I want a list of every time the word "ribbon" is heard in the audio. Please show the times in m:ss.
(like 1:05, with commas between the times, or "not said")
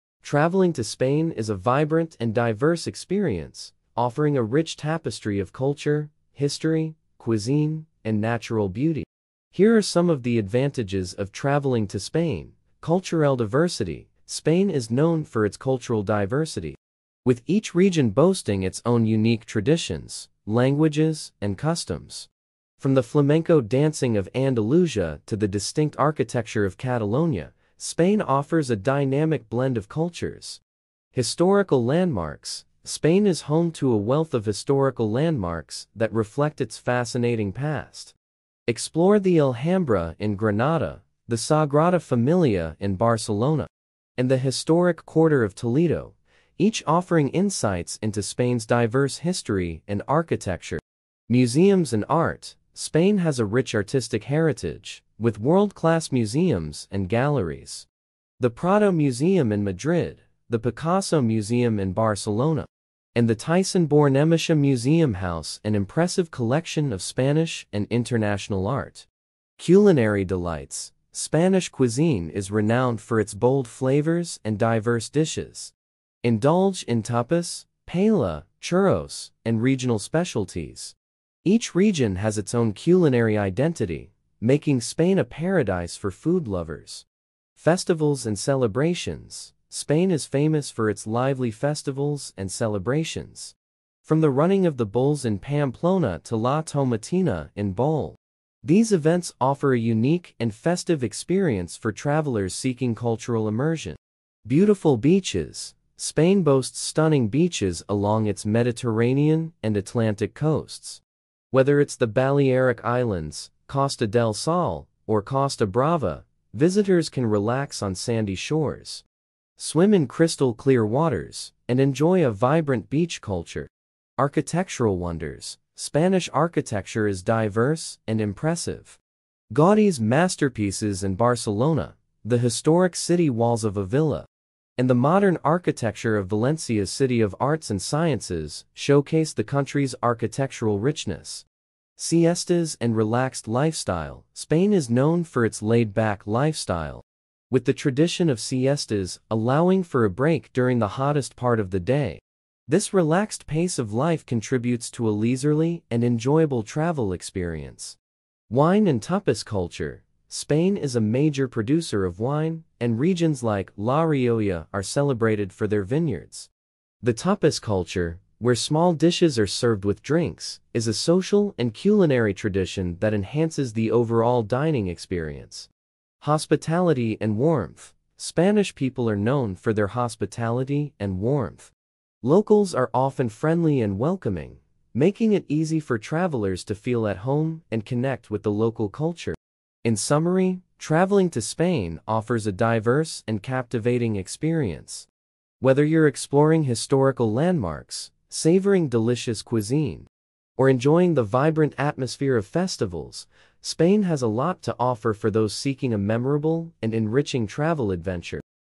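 not said.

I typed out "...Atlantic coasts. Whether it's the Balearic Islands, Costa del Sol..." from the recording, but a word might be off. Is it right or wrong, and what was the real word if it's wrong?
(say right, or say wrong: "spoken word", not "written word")
right.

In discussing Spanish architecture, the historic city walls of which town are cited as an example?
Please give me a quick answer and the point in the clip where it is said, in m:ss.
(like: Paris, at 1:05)
Avila, at 2:13.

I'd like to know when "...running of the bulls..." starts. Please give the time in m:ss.
1:34.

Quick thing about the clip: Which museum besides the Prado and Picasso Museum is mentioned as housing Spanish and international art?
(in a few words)
Thyssen Bornemisza Museum.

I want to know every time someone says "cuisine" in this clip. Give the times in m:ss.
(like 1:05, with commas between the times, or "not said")
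0:07, 1:11, 3:19.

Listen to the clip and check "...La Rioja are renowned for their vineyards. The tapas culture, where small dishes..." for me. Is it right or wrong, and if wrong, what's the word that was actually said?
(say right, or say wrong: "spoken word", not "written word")
wrong: "celebrated", not "renowned".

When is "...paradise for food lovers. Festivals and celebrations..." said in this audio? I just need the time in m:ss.
1:25.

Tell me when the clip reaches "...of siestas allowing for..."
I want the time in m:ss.
2:28.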